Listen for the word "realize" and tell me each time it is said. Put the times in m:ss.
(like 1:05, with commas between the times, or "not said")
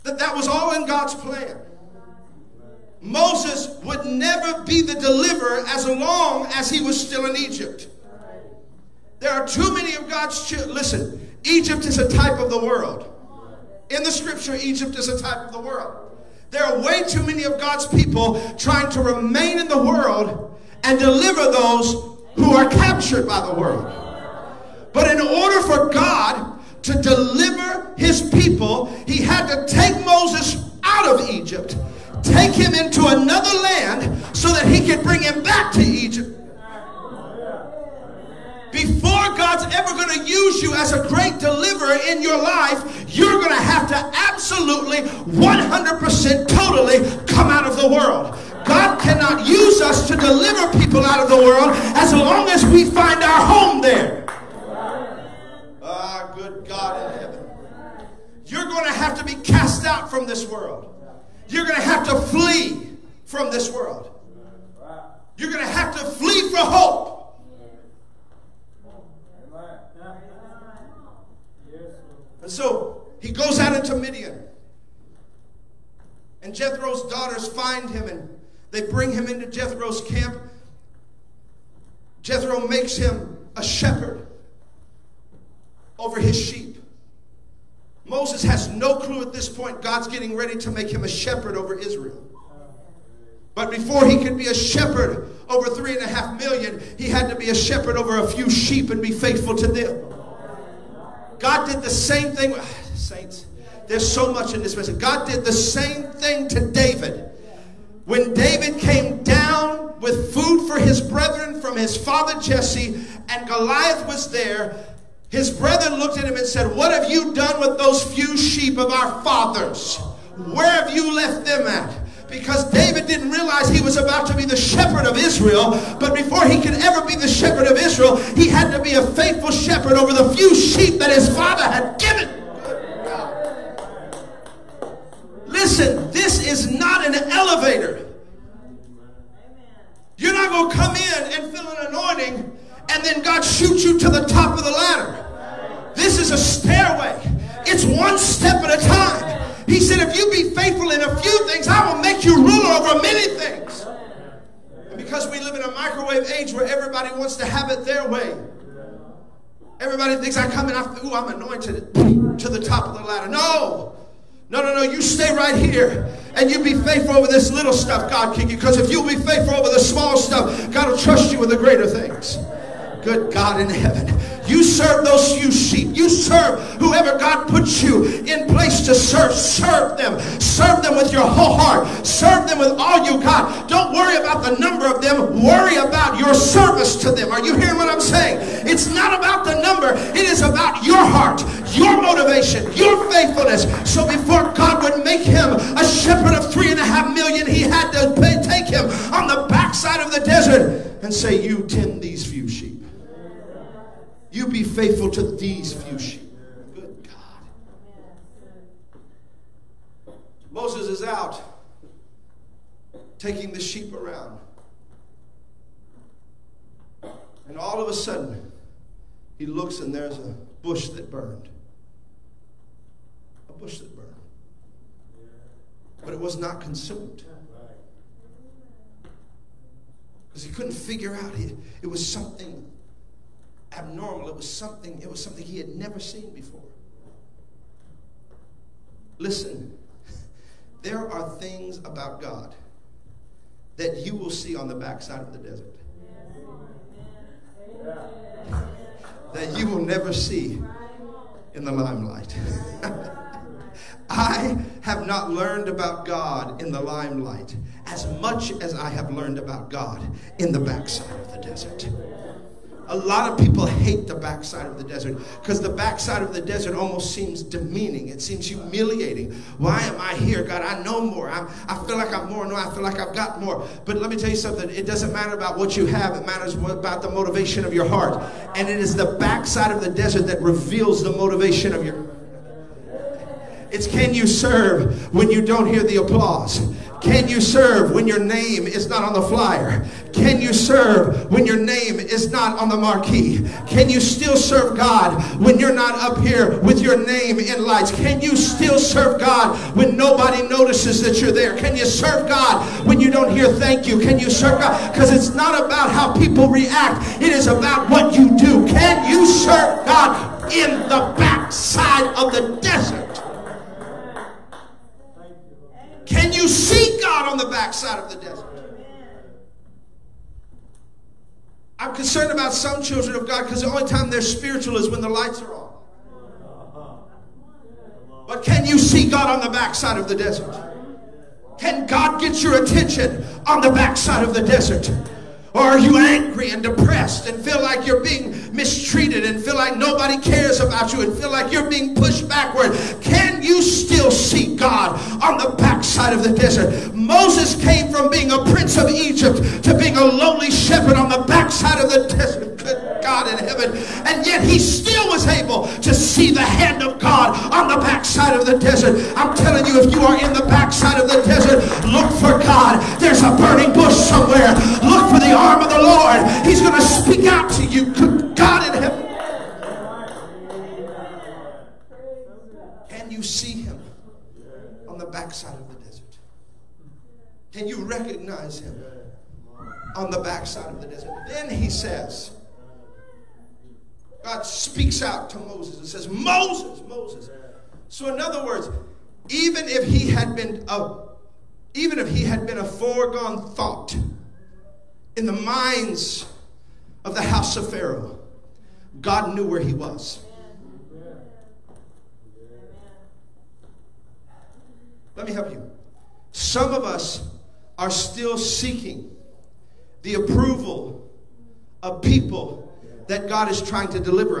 2:03.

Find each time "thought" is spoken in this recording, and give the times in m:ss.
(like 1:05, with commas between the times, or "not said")
6:33.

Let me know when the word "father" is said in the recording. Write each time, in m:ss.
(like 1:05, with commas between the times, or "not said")
1:51, 1:59, 2:11.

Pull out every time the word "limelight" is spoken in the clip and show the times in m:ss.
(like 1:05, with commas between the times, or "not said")
4:11, 4:16.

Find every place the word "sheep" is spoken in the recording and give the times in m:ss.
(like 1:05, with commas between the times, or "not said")
1:26, 1:38, 1:58, 2:10, 2:55, 3:25, 3:33.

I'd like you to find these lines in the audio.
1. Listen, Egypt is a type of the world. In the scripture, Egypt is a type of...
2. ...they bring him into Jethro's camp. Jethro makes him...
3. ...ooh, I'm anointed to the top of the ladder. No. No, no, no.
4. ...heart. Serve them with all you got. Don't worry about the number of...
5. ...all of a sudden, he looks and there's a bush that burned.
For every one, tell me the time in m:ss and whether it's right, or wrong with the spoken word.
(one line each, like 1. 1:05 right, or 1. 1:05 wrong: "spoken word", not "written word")
1. 0:10 right
2. 1:18 right
3. 2:41 right
4. 3:01 right
5. 3:37 right.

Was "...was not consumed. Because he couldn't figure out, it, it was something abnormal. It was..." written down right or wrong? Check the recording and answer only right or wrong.
right.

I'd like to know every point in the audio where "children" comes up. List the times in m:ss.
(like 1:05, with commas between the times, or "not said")
0:10, 5:22.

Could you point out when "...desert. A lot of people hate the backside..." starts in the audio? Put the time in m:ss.
4:21.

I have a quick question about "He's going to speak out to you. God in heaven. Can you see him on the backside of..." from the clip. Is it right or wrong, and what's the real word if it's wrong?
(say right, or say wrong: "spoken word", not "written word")
right.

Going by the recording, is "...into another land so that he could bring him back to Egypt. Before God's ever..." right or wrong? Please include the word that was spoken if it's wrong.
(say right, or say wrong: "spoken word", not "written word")
right.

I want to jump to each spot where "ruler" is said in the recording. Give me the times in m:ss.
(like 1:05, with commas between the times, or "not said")
2:32.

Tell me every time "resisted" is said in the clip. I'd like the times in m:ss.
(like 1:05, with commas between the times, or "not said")
not said.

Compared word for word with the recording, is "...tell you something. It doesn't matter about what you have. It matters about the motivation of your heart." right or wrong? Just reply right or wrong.
right.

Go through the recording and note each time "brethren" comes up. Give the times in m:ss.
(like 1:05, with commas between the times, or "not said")
1:51, 1:55.